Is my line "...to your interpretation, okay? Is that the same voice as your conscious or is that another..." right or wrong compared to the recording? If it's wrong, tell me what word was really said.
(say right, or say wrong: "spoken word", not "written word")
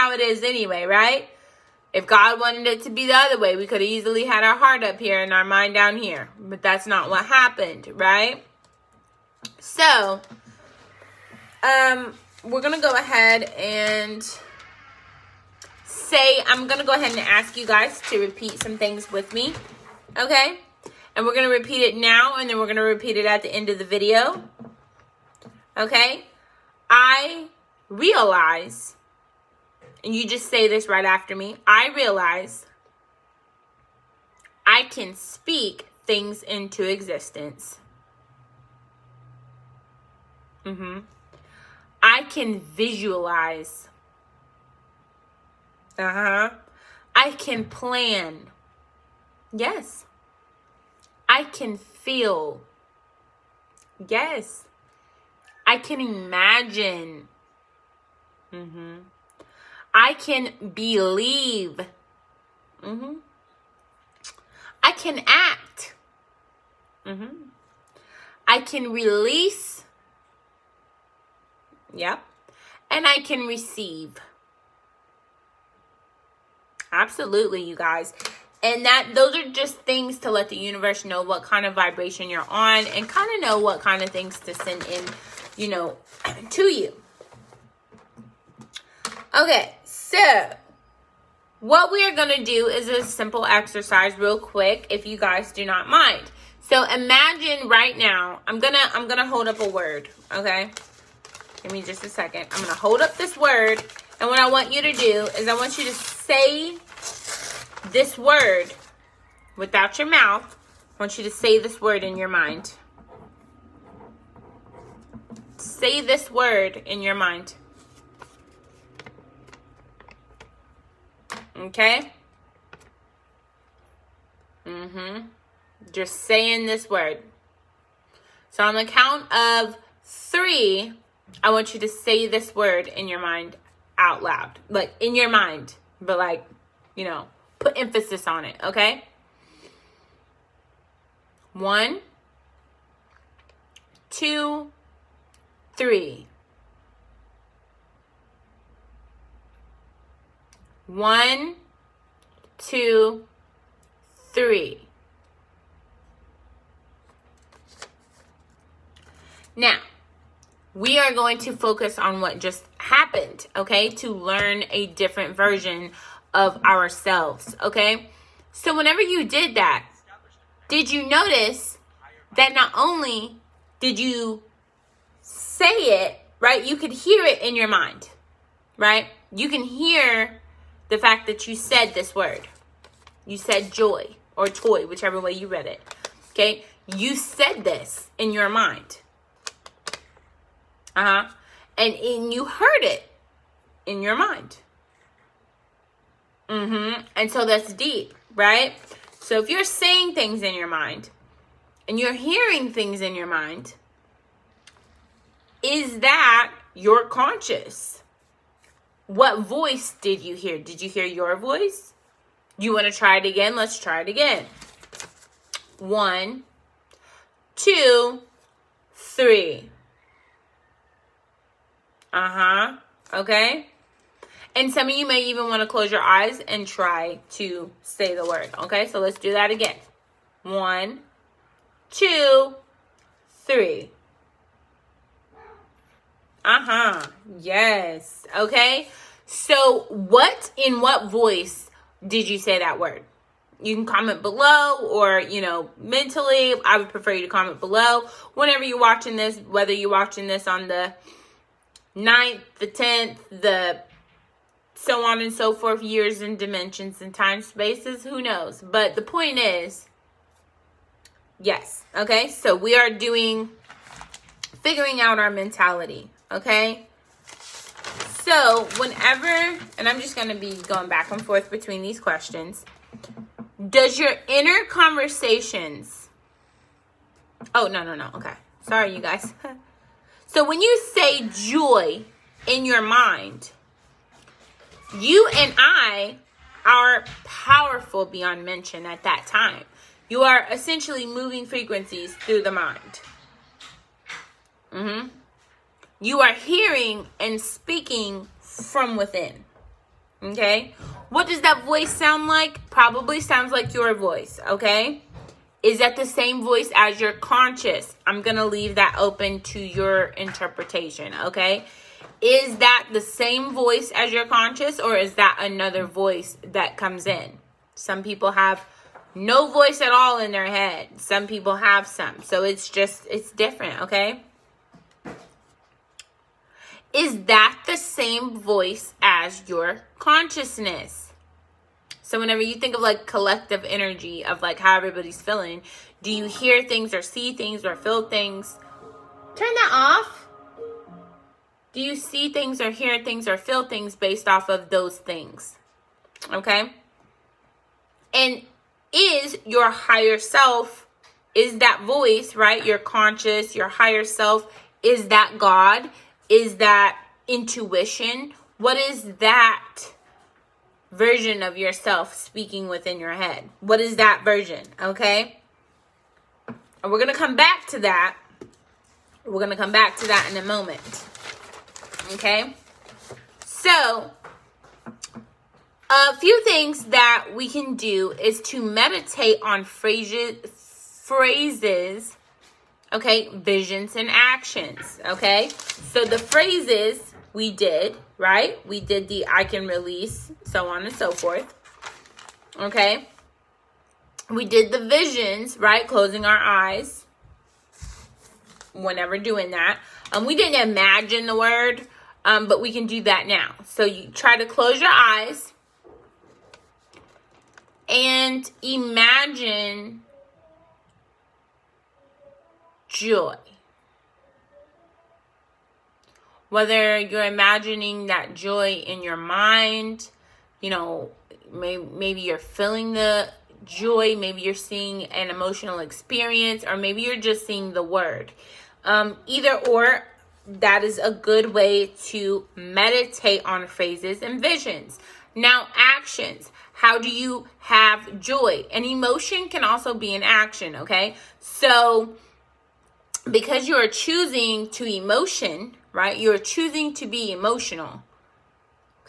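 right.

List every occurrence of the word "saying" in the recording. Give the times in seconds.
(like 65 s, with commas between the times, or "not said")
126 s, 199 s.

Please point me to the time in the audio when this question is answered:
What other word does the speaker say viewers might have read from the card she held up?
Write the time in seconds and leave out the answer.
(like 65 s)
184 s.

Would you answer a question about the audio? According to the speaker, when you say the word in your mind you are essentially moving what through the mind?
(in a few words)
frequencies.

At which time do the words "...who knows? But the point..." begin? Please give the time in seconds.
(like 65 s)
258 s.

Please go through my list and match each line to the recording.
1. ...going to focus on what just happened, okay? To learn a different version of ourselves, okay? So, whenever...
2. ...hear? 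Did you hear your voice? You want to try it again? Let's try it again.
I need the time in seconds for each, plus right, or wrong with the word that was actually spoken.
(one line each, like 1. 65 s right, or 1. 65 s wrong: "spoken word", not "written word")
1. 161 s right
2. 210 s right.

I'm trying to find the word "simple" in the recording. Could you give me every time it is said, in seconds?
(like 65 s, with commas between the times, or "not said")
93 s.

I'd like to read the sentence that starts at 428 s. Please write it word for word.
Um, either or, that is a good way to meditate on phrases and visions.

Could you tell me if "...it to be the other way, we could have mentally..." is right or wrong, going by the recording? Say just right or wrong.
wrong.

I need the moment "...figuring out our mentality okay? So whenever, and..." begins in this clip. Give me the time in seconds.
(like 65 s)
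264 s.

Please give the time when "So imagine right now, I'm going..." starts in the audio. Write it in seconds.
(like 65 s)
96 s.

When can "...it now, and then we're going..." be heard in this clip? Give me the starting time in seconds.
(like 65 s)
21 s.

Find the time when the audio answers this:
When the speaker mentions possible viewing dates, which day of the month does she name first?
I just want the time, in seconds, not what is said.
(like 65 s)
250 s.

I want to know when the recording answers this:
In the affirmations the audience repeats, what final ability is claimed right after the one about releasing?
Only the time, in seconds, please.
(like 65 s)
73 s.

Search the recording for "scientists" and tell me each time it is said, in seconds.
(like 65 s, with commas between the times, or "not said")
not said.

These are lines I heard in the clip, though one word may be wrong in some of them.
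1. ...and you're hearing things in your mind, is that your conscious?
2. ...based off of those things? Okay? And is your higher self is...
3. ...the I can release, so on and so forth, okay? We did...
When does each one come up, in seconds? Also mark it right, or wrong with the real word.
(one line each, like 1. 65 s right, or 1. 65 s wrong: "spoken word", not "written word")
1. 201 s right
2. 343 s right
3. 389 s right.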